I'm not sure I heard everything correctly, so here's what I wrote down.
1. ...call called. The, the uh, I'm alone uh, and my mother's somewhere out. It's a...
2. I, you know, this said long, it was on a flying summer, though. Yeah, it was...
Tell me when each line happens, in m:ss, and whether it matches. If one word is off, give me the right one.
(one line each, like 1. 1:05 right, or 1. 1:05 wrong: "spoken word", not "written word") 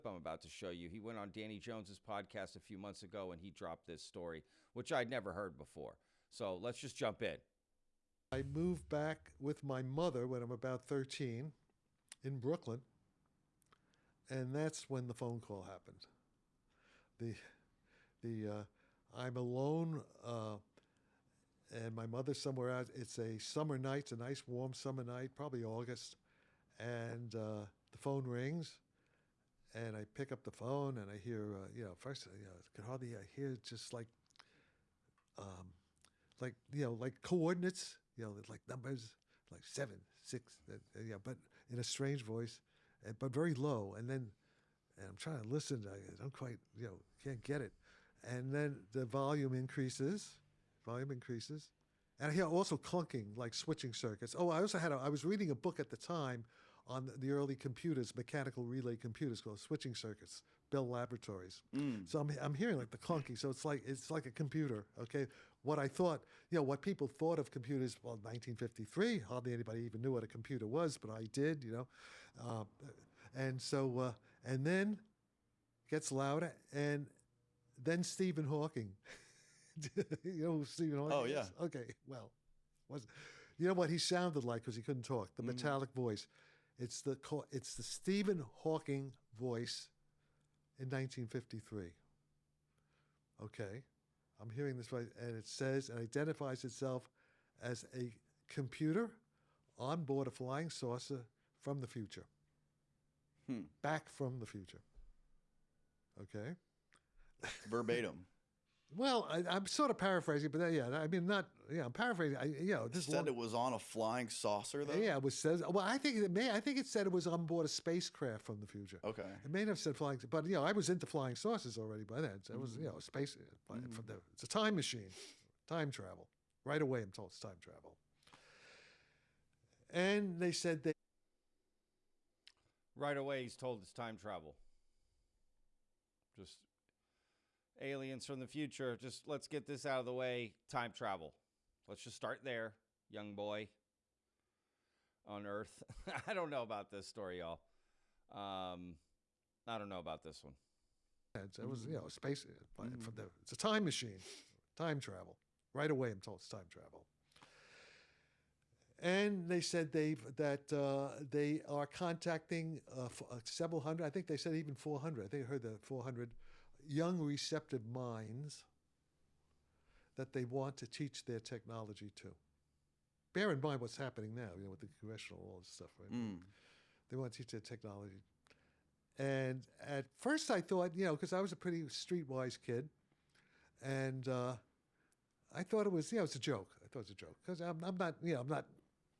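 1. 0:15 wrong: "happened", not "called"
2. 1:52 wrong: "saucer", not "summer".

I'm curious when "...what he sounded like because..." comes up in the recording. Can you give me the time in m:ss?
1:23.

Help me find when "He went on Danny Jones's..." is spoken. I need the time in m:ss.
0:00.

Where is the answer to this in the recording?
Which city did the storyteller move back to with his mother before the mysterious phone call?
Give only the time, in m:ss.
0:12.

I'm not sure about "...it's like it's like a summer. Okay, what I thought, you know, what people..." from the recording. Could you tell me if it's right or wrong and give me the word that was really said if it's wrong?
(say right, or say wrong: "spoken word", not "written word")
wrong: "computer", not "summer".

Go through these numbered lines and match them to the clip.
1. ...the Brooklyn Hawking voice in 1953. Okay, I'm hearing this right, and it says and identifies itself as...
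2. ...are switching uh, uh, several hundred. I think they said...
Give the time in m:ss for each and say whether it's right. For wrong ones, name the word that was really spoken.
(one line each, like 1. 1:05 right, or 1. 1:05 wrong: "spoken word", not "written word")
1. 1:27 wrong: "Stephen", not "Brooklyn"
2. 2:41 wrong: "contacting", not "switching".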